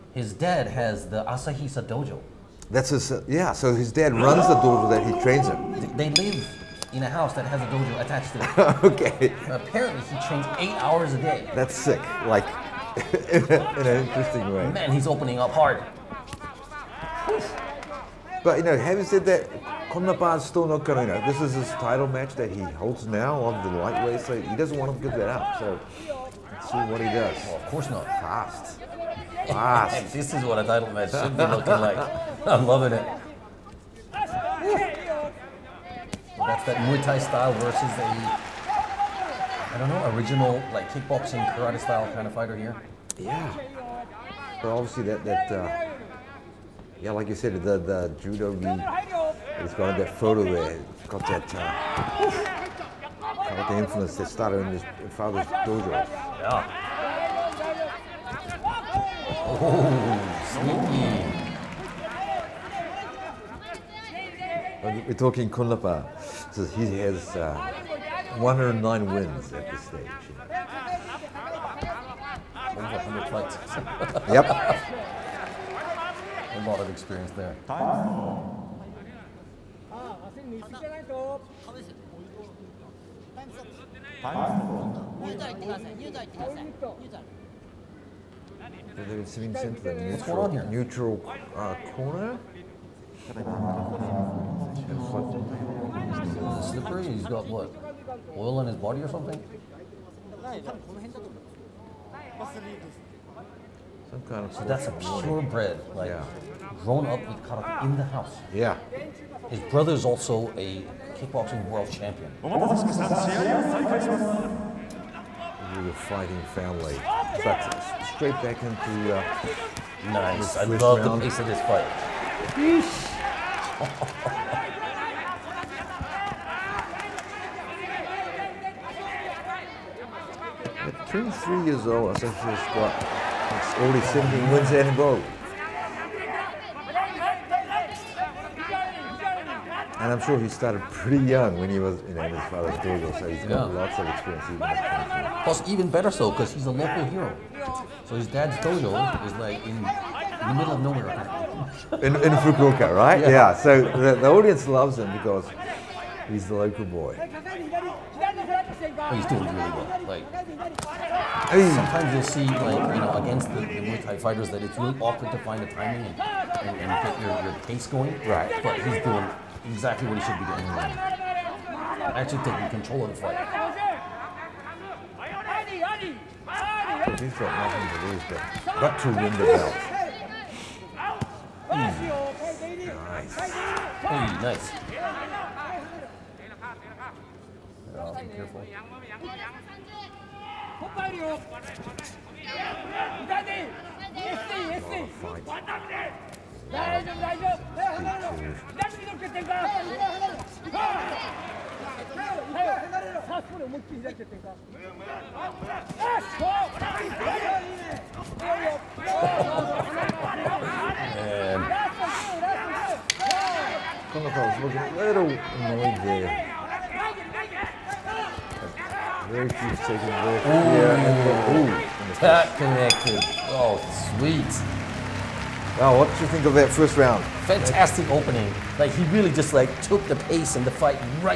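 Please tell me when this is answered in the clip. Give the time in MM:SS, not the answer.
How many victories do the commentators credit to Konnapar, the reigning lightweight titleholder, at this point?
01:08.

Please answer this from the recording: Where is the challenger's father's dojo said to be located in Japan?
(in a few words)
Fukuoka.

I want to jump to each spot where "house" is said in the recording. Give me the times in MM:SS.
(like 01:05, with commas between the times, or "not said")
00:07, 01:48.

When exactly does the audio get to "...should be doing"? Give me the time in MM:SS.
02:50.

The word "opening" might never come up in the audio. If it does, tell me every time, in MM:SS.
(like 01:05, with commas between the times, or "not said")
00:15, 03:48.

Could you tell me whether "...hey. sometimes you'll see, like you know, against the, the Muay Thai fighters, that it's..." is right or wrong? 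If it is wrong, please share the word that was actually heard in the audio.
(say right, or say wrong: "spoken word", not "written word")
right.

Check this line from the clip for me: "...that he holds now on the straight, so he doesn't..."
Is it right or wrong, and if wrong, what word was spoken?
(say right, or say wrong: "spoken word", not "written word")
wrong: "lightweight", not "straight".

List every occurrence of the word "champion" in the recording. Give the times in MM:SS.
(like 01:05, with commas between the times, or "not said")
01:51.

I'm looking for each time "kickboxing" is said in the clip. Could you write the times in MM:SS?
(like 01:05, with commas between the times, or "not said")
00:40, 01:51.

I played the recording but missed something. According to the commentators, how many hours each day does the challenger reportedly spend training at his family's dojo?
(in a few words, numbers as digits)
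8.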